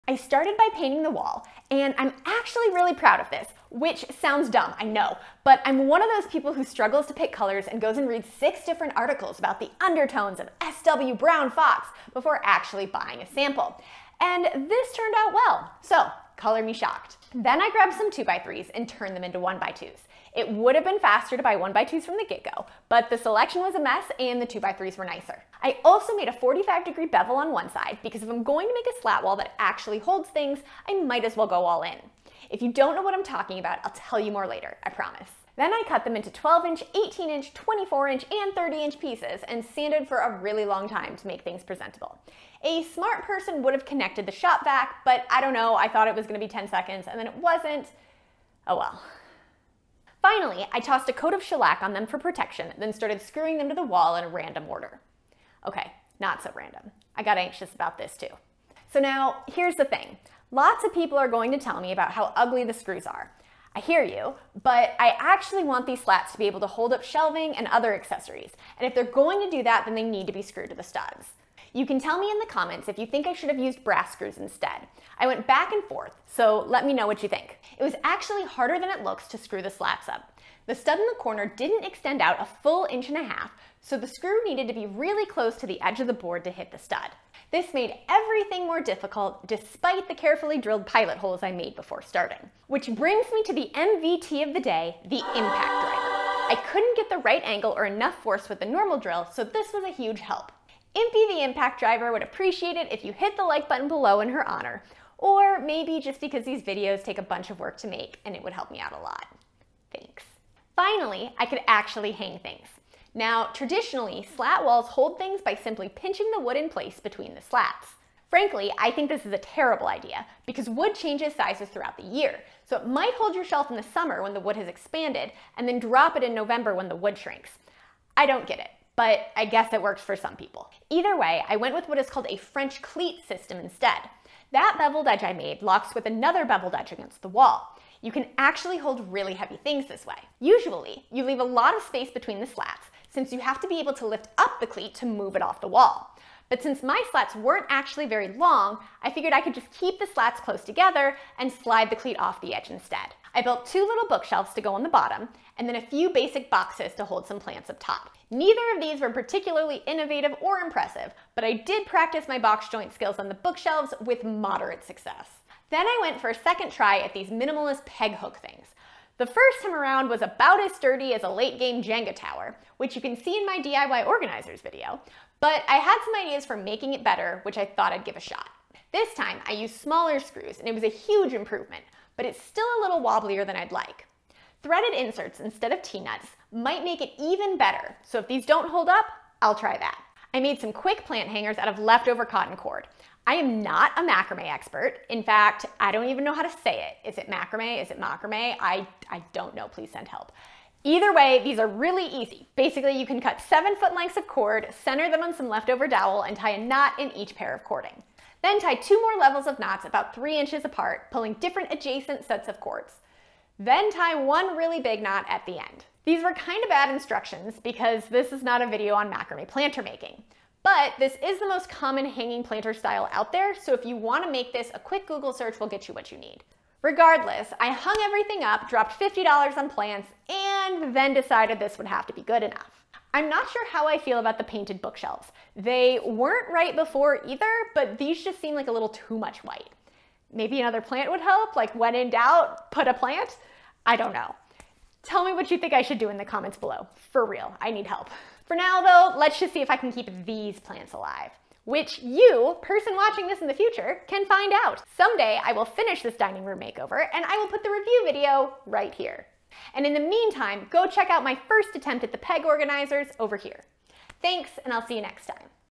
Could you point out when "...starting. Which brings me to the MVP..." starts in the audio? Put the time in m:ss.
1:32.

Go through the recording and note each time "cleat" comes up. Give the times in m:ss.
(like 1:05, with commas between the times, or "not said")
2:12, 2:24, 2:31.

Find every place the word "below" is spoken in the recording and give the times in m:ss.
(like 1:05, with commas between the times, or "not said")
1:43, 4:06.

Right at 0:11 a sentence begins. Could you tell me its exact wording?
Brown Fox before actually buying a sample.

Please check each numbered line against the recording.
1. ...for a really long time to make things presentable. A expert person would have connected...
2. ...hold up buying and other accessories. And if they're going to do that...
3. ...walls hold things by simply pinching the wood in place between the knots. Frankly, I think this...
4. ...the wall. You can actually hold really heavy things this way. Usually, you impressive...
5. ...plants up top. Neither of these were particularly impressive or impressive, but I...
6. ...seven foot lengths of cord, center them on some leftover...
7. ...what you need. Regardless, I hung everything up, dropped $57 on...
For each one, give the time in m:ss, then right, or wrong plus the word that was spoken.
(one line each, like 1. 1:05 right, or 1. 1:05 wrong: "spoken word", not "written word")
1. 0:40 wrong: "smart", not "expert"
2. 1:06 wrong: "shelving", not "buying"
3. 1:54 wrong: "slats", not "knots"
4. 2:17 wrong: "leave", not "impressive"
5. 2:37 wrong: "innovative", not "impressive"
6. 3:23 right
7. 3:45 wrong: "50", not "57".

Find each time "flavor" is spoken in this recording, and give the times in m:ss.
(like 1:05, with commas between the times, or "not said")
not said.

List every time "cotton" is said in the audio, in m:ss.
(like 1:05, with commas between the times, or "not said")
3:12.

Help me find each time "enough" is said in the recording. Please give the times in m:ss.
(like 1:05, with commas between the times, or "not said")
1:37, 3:52.